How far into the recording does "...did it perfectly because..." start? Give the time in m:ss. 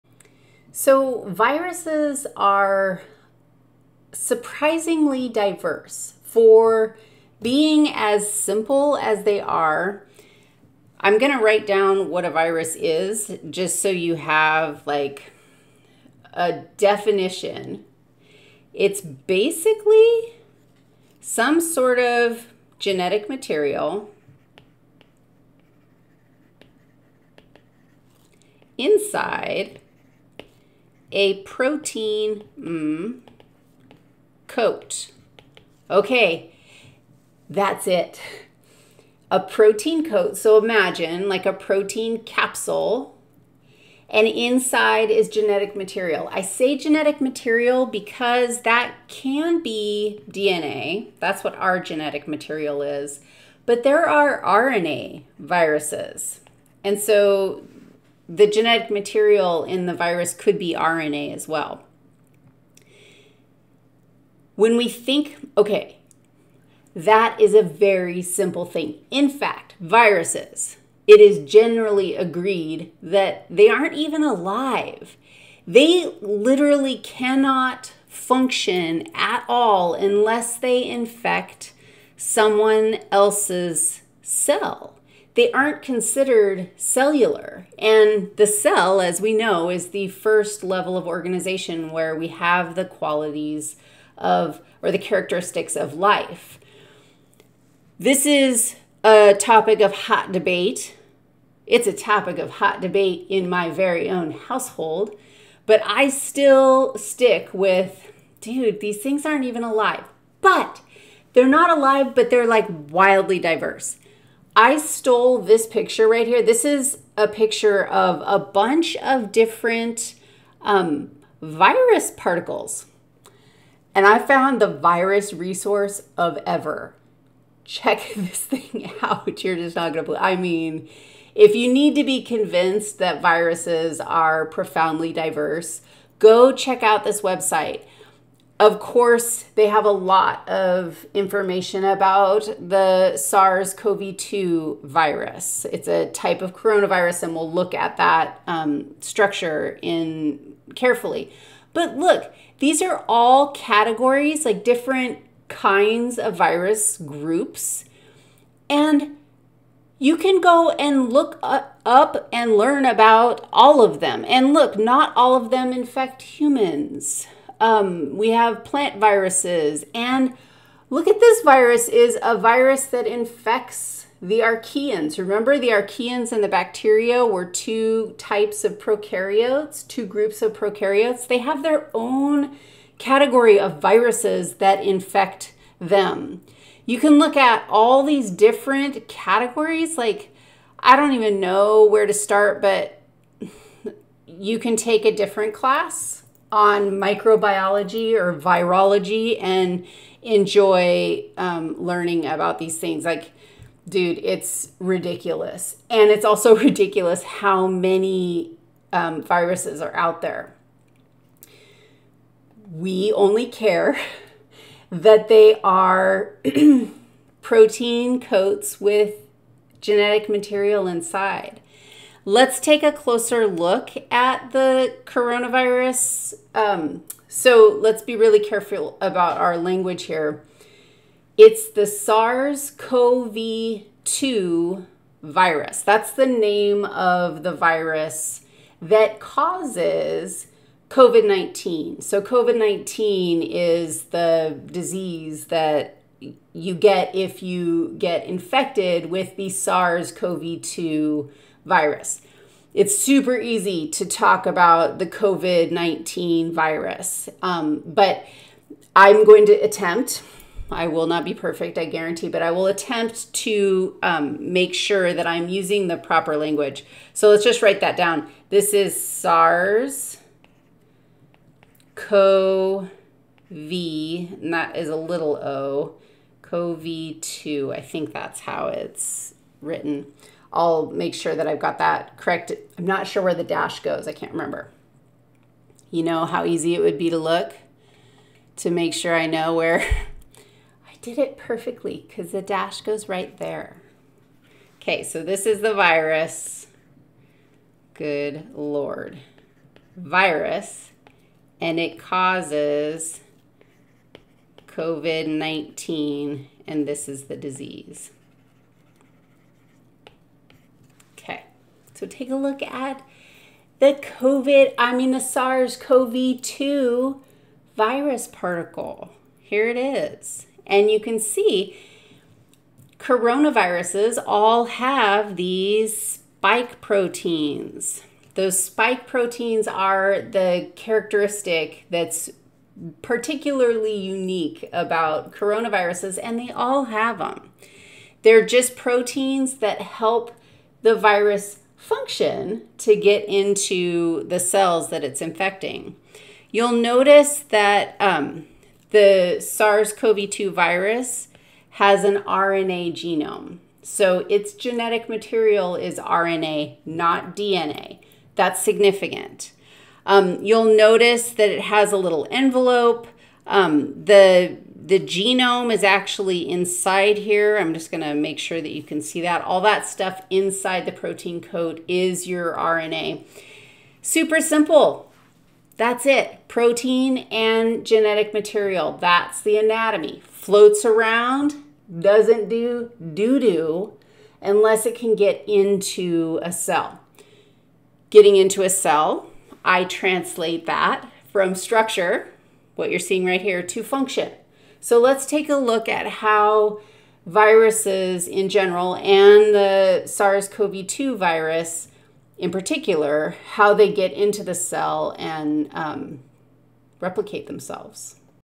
4:51.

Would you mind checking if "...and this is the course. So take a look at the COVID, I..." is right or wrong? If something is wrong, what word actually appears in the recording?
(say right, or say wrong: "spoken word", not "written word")
wrong: "disease", not "course".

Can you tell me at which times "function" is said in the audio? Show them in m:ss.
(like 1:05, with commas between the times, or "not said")
1:18, 5:41, 6:33.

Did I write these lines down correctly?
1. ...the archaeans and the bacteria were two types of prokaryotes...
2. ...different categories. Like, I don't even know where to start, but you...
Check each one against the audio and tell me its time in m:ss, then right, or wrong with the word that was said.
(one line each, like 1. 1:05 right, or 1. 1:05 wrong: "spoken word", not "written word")
1. 2:55 right
2. 3:08 right.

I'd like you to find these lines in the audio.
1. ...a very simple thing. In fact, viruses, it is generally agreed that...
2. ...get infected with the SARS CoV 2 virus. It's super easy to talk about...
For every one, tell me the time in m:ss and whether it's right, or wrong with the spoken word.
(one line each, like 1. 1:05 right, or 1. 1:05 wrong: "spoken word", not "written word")
1. 1:07 right
2. 4:07 right.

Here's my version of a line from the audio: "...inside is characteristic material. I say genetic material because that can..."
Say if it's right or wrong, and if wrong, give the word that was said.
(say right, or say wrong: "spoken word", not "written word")
wrong: "genetic", not "characteristic".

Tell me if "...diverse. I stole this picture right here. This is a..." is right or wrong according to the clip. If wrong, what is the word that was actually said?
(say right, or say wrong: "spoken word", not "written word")
right.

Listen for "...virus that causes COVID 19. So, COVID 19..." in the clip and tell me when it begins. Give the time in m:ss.
3:57.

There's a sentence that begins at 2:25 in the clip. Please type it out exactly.
It's a type of coronavirus, and we'll look at that um, structure in carefully.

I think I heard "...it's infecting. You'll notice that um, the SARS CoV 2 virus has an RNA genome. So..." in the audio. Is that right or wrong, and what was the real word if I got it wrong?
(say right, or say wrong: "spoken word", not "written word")
right.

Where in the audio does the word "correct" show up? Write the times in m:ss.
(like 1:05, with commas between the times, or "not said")
4:42.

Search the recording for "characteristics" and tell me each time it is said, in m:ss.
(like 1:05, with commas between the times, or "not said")
1:34, 5:30.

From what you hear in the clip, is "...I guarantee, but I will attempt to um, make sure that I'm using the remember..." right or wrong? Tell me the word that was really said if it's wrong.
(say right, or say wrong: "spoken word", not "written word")
wrong: "proper", not "remember".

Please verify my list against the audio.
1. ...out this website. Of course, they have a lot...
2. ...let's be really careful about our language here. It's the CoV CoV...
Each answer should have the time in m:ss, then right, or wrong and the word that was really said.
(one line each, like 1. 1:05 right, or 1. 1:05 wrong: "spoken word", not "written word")
1. 2:16 right
2. 3:47 wrong: "SARS", not "CoV".